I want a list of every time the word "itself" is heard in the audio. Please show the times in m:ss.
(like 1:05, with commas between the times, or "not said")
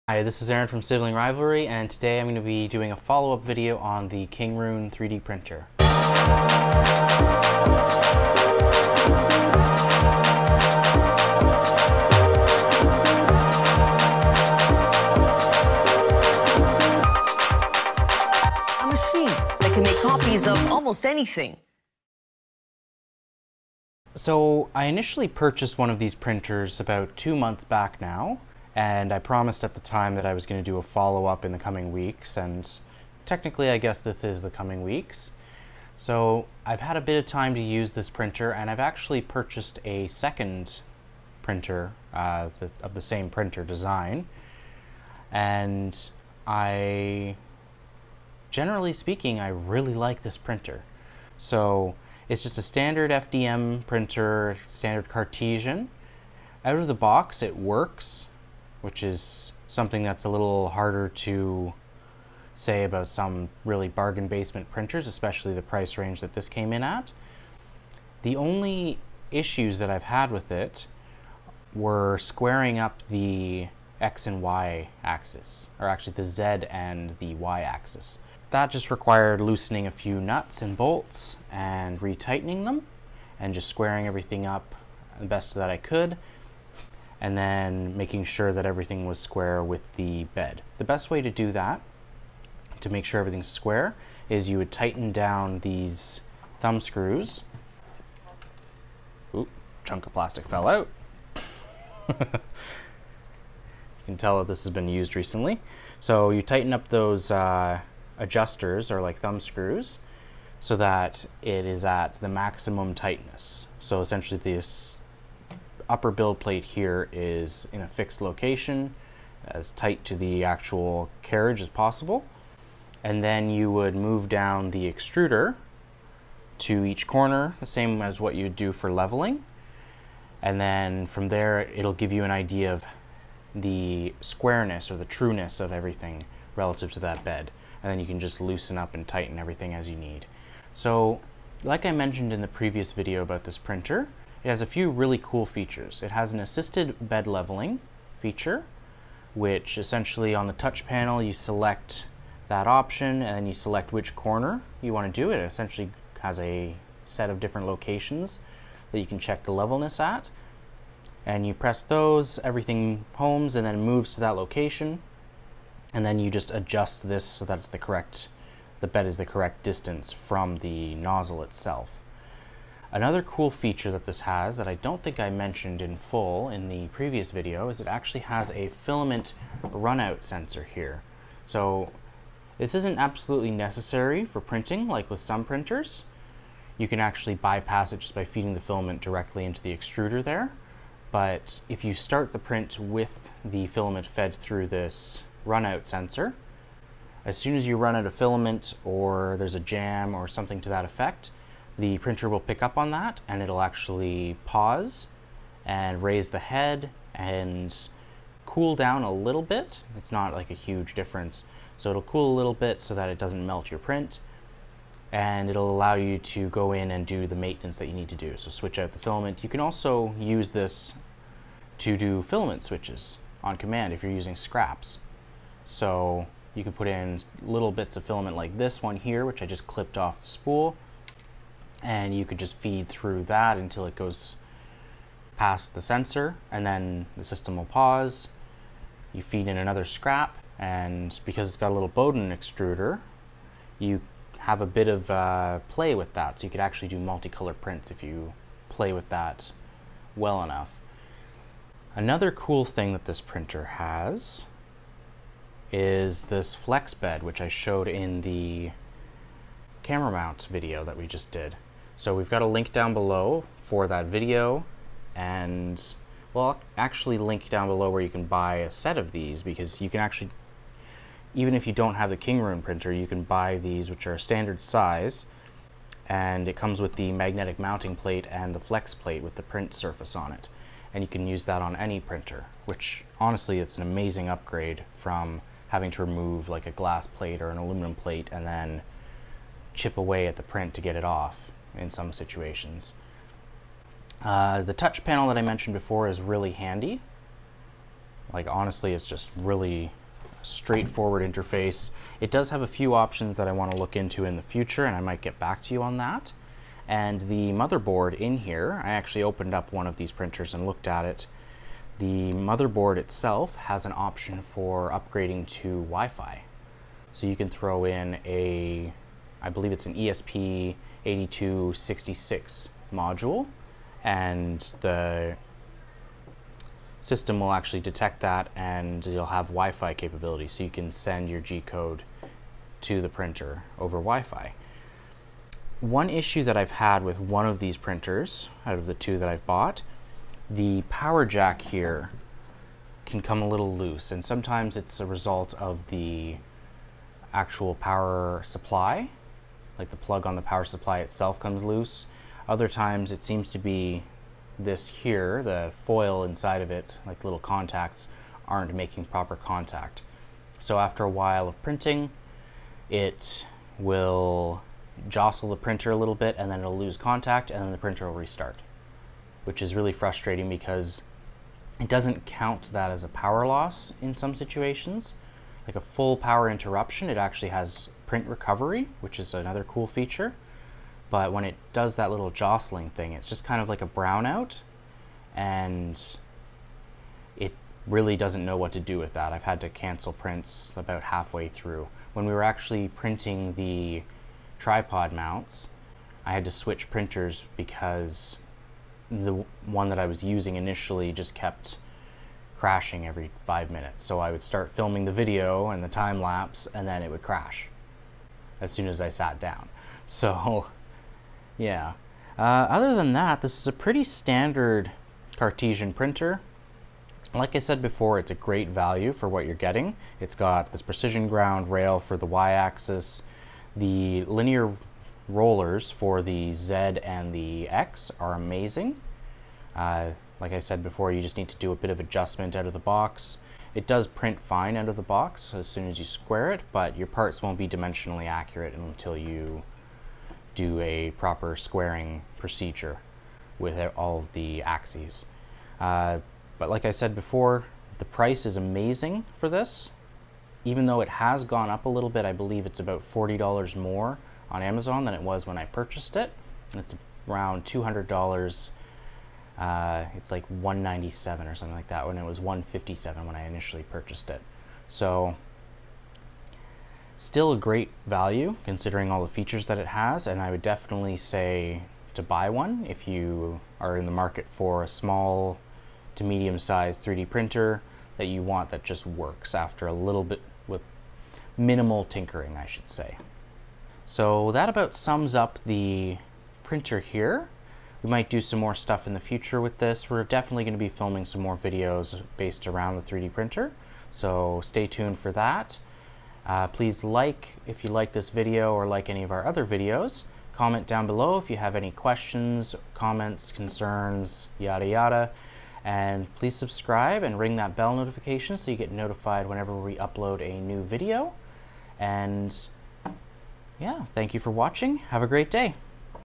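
2:51, 5:12, 5:50.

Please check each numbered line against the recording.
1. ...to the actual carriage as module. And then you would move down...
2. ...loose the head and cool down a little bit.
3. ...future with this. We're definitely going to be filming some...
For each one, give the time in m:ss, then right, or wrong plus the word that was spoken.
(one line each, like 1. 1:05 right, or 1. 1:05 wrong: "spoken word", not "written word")
1. 2:00 wrong: "possible", not "module"
2. 3:26 wrong: "raise", not "loose"
3. 8:09 right.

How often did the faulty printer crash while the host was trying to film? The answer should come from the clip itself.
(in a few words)
every 5 minutes.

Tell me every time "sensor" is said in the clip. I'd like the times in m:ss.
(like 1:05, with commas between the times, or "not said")
3:00, 3:15, 3:55.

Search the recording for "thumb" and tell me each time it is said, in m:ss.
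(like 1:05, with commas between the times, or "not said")
1:36, 1:49.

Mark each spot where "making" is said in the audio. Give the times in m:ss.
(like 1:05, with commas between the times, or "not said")
1:27, 5:58.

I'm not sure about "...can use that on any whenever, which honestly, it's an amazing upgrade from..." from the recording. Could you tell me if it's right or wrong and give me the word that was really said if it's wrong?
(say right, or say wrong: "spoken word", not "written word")
wrong: "printer", not "whenever".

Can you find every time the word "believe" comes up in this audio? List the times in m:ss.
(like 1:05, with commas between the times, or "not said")
5:19, 7:32.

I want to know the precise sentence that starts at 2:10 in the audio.
And then from there, it'll give you an idea of the squareness or the trueness of everything relative to that bed.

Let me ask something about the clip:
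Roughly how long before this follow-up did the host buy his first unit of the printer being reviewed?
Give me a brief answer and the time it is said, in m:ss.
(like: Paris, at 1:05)
two months, at 0:27.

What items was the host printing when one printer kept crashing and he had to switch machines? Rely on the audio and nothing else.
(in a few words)
tripod mounts.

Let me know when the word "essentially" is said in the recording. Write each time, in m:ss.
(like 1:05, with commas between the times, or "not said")
1:54, 2:29, 2:35.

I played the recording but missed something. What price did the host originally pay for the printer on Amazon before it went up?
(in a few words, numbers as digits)
$157.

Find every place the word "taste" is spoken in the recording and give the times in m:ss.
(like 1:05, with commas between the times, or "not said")
not said.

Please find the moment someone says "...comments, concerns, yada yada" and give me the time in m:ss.
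8:22.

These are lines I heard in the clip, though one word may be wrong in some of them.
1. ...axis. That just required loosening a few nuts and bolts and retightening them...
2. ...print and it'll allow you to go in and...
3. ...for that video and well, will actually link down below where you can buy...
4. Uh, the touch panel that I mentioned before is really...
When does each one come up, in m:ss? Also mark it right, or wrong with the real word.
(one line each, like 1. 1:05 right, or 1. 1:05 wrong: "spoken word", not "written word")
1. 1:17 right
2. 3:33 right
3. 4:23 right
4. 4:54 right.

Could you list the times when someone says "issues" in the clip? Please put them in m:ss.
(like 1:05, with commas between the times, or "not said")
1:09, 5:36.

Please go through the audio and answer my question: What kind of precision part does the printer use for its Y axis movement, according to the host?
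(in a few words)
precision ground rail.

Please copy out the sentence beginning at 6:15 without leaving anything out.
Like a full power interruption, it actually has print recovery, which is another cool feature.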